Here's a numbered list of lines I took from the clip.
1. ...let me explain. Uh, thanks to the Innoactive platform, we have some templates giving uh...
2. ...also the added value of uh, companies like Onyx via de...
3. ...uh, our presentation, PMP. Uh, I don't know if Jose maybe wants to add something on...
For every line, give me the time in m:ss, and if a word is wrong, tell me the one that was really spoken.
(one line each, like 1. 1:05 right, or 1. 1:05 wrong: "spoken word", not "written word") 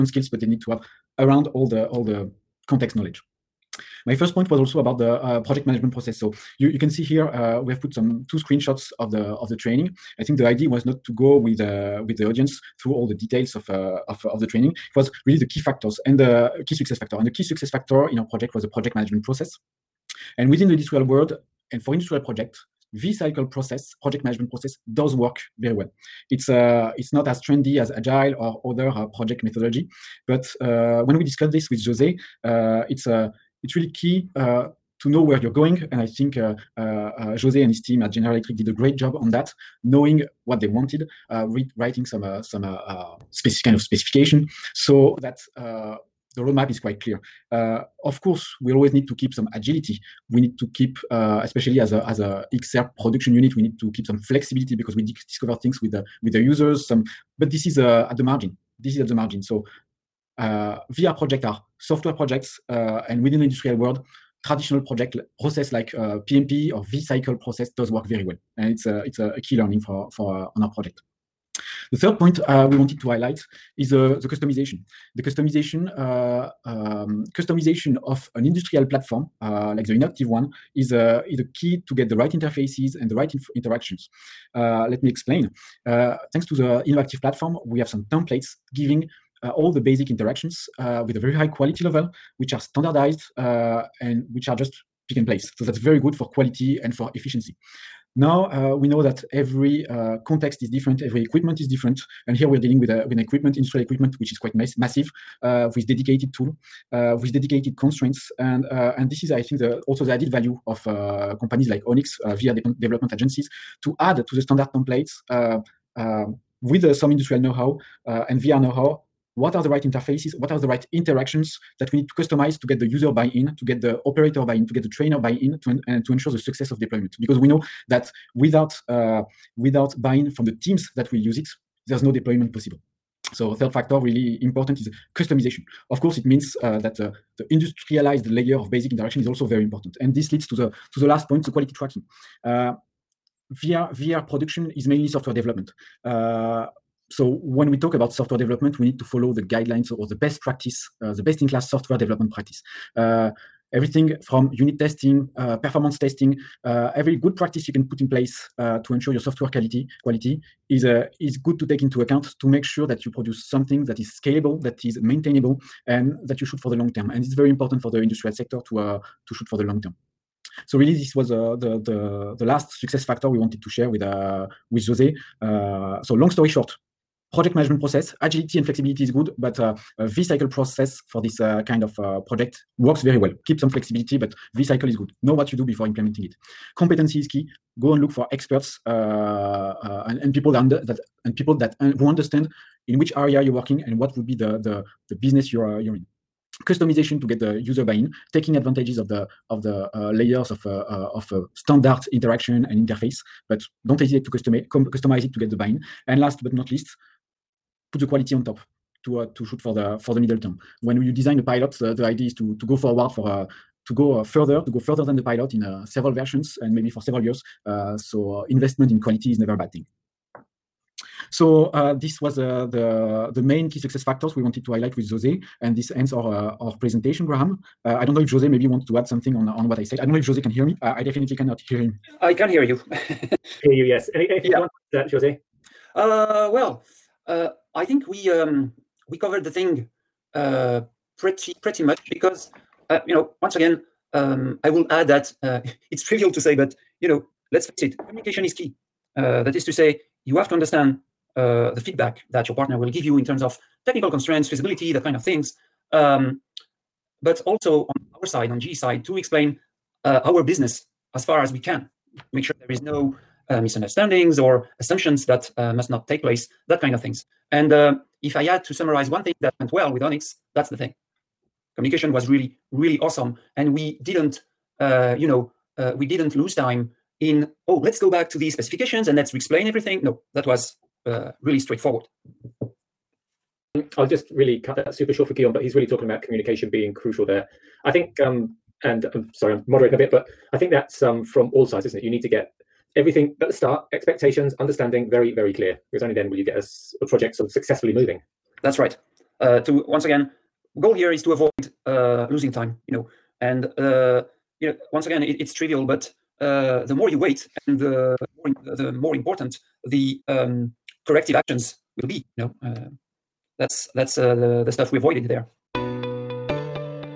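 1. 1:24 right
2. 1:49 right
3. 3:46 wrong: "Graham", not "PMP".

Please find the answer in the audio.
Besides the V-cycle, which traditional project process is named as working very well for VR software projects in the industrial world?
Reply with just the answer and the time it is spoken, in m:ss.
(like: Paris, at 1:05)
PMP, at 1:06.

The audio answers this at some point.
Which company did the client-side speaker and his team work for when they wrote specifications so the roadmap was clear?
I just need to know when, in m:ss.
0:38.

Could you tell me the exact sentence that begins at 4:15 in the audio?
Um, but also on our side, on G side, to explain uh, our business as far as we can.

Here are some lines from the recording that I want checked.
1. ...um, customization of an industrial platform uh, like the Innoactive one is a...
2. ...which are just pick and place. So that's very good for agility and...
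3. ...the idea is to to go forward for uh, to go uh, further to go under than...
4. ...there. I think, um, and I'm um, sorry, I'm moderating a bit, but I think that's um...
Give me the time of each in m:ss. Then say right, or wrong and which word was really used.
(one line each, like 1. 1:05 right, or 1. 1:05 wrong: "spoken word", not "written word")
1. 1:16 right
2. 1:34 wrong: "quality", not "agility"
3. 3:31 wrong: "further", not "under"
4. 4:47 right.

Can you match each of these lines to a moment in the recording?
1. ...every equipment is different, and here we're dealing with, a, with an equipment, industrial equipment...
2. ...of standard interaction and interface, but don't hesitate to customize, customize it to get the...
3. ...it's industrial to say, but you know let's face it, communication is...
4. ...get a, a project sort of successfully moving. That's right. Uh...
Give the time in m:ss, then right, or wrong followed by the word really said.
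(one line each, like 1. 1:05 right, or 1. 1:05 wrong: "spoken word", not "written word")
1. 1:41 right
2. 3:21 right
3. 4:05 wrong: "trivial", not "industrial"
4. 4:56 right.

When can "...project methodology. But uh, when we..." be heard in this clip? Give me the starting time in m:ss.
0:29.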